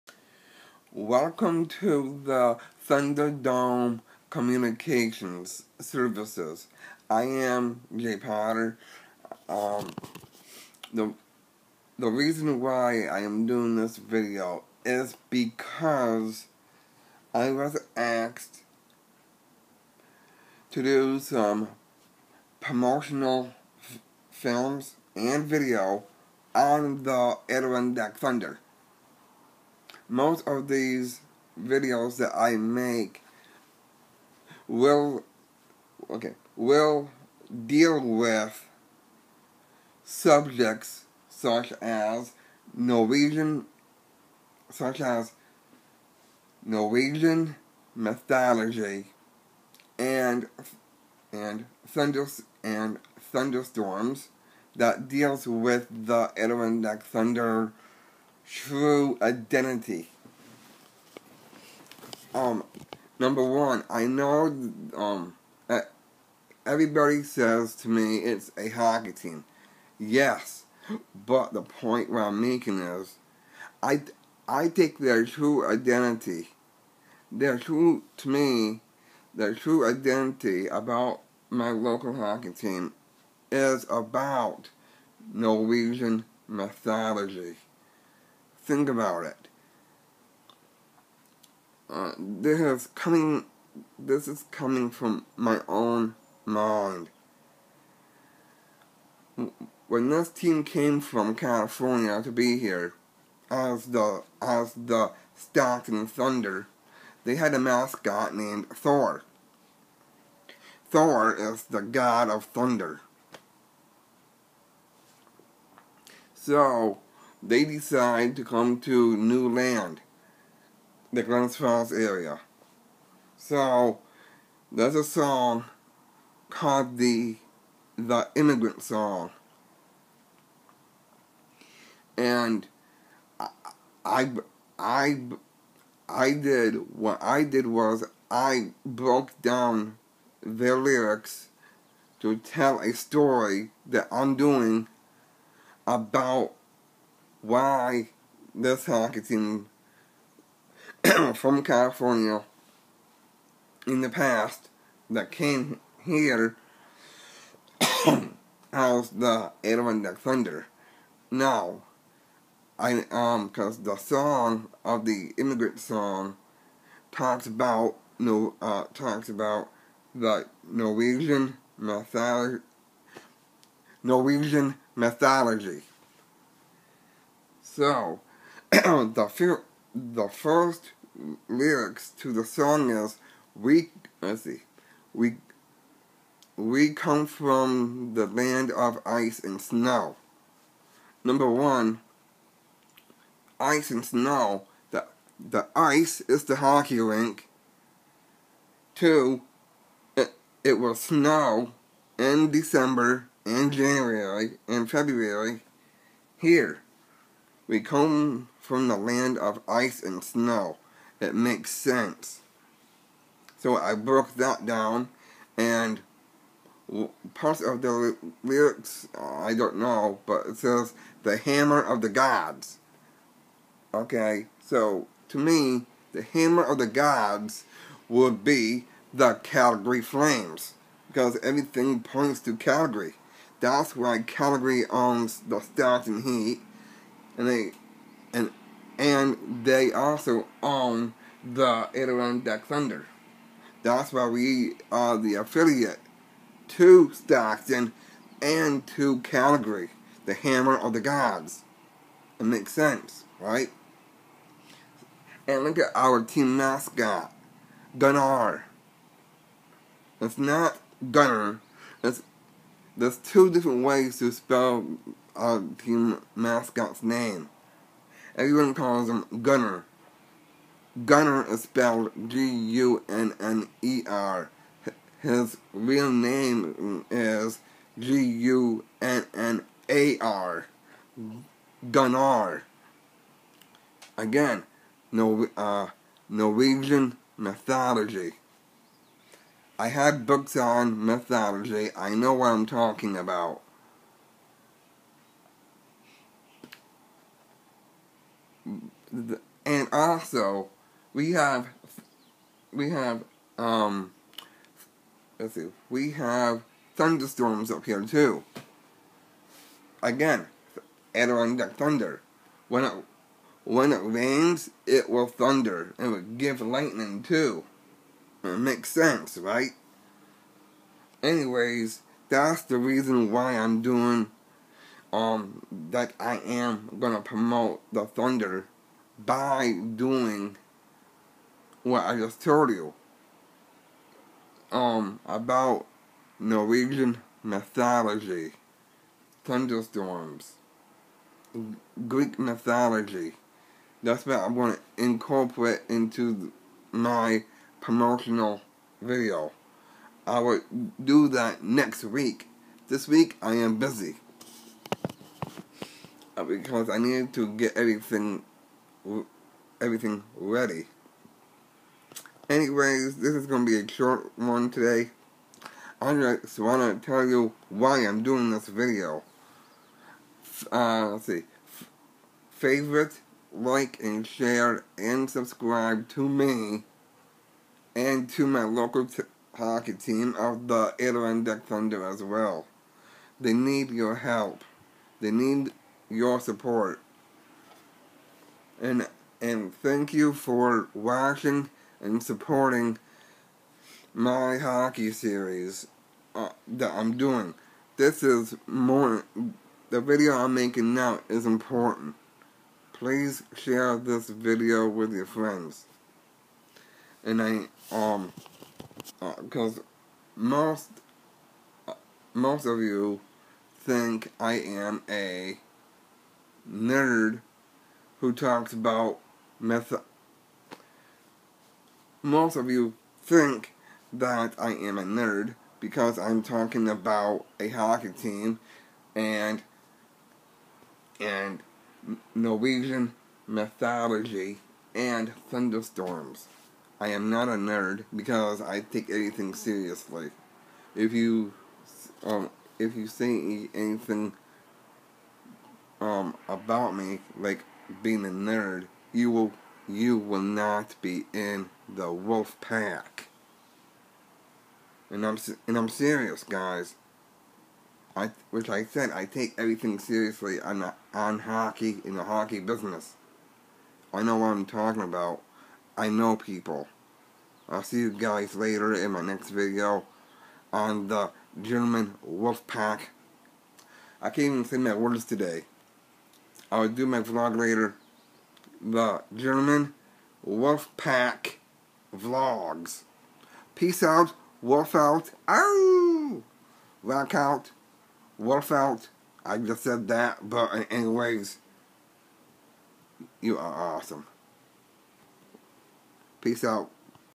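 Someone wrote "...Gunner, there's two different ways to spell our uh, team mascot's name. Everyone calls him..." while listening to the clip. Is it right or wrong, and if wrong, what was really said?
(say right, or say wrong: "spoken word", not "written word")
right.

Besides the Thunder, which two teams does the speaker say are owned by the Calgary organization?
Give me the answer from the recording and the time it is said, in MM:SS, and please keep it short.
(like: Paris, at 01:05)
Stars and Heat, at 03:55.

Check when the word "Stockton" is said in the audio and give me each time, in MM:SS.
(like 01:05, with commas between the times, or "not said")
01:45, 04:07.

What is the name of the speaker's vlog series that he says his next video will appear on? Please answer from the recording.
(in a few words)
German Wolfpack Vlogs.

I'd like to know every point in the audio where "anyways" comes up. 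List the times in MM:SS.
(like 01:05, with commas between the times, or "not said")
05:21, 06:02, 08:10.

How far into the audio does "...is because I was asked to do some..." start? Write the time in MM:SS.
00:14.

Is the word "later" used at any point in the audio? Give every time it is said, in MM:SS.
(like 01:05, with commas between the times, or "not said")
07:48, 07:57.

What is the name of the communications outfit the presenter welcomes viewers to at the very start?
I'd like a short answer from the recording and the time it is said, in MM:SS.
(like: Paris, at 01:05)
Thunderdome Communications Services, at 00:02.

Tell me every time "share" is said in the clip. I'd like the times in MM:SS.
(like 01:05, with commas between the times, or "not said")
06:14, 06:43.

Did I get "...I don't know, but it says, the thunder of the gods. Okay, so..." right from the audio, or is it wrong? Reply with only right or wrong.
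wrong.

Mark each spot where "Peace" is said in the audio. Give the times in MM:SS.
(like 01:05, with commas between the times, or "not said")
08:03, 08:16.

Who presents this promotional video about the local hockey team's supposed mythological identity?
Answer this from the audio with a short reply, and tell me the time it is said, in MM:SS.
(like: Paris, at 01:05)
Jay Potter, at 00:07.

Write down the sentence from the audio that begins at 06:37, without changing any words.
This is more the video I'm making now is important.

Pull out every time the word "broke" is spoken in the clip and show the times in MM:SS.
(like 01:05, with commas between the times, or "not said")
02:18, 03:33.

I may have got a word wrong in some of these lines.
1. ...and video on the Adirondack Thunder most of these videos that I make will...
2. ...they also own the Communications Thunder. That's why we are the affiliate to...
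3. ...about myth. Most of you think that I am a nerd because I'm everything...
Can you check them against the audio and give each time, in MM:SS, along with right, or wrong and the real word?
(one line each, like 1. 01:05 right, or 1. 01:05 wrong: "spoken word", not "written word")
1. 00:25 right
2. 03:59 wrong: "Adirondack", not "Communications"
3. 06:58 wrong: "talking", not "everything".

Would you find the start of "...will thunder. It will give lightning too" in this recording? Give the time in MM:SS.
05:15.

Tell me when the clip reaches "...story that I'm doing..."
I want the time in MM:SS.
02:22.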